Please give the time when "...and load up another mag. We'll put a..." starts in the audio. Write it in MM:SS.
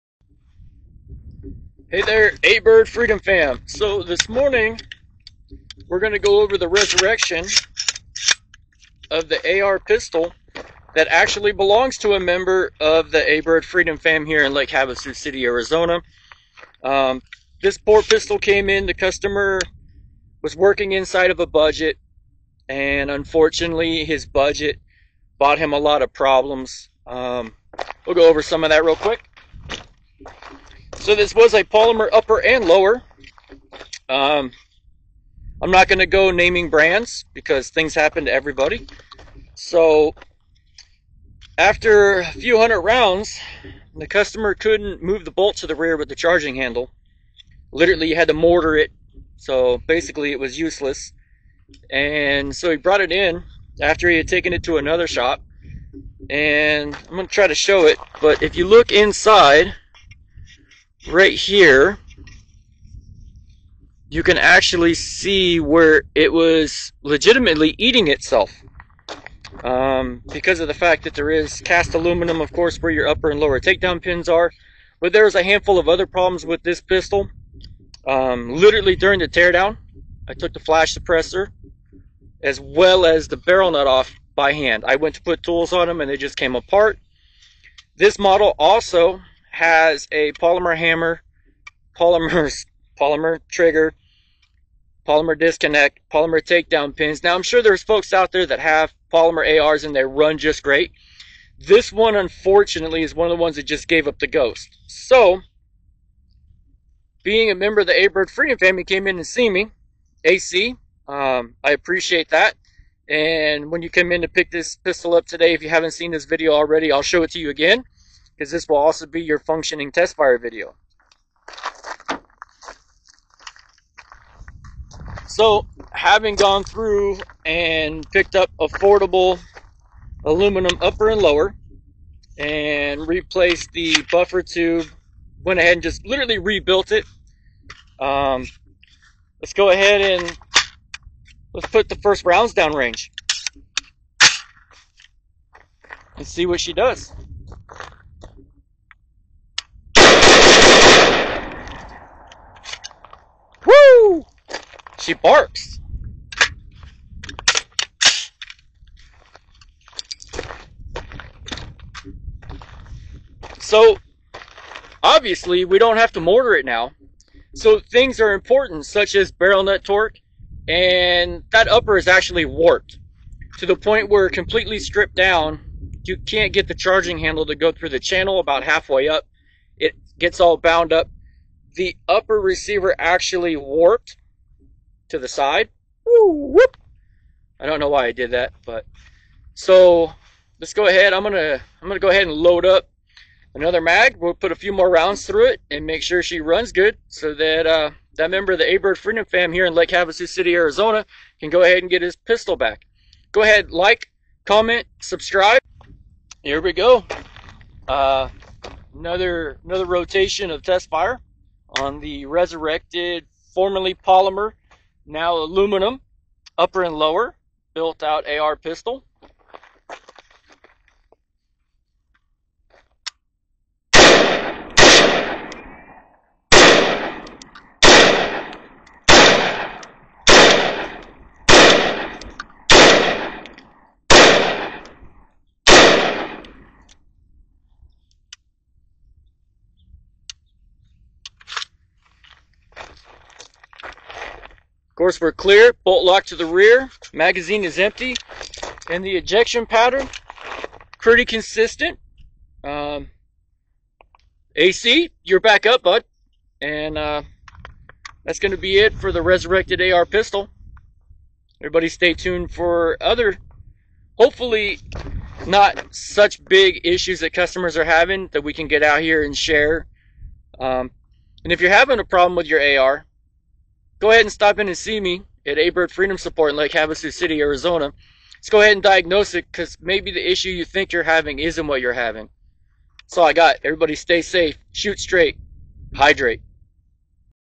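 03:12.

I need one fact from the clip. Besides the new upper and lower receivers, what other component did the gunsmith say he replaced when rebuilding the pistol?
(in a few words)
buffer tube.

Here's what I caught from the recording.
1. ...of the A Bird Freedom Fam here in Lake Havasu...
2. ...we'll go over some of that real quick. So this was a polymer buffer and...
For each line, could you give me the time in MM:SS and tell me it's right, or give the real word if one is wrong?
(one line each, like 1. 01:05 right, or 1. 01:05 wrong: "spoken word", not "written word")
1. 00:12 right
2. 00:28 wrong: "upper", not "buffer".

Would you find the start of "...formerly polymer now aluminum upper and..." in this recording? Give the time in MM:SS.
03:33.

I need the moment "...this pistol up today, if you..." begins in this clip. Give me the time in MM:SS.
01:54.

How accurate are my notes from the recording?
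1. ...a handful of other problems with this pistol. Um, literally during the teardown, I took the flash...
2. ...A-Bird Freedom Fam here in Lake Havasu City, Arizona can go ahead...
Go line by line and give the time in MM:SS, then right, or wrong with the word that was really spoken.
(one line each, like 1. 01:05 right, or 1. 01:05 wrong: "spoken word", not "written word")
1. 01:15 right
2. 03:18 right.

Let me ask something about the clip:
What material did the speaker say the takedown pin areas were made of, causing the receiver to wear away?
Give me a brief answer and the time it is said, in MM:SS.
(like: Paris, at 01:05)
cast aluminum, at 01:11.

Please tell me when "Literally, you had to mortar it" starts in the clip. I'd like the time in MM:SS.
00:47.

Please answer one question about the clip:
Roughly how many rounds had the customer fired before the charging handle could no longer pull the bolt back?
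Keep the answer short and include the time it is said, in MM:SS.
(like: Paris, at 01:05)
a few hundred, at 00:42.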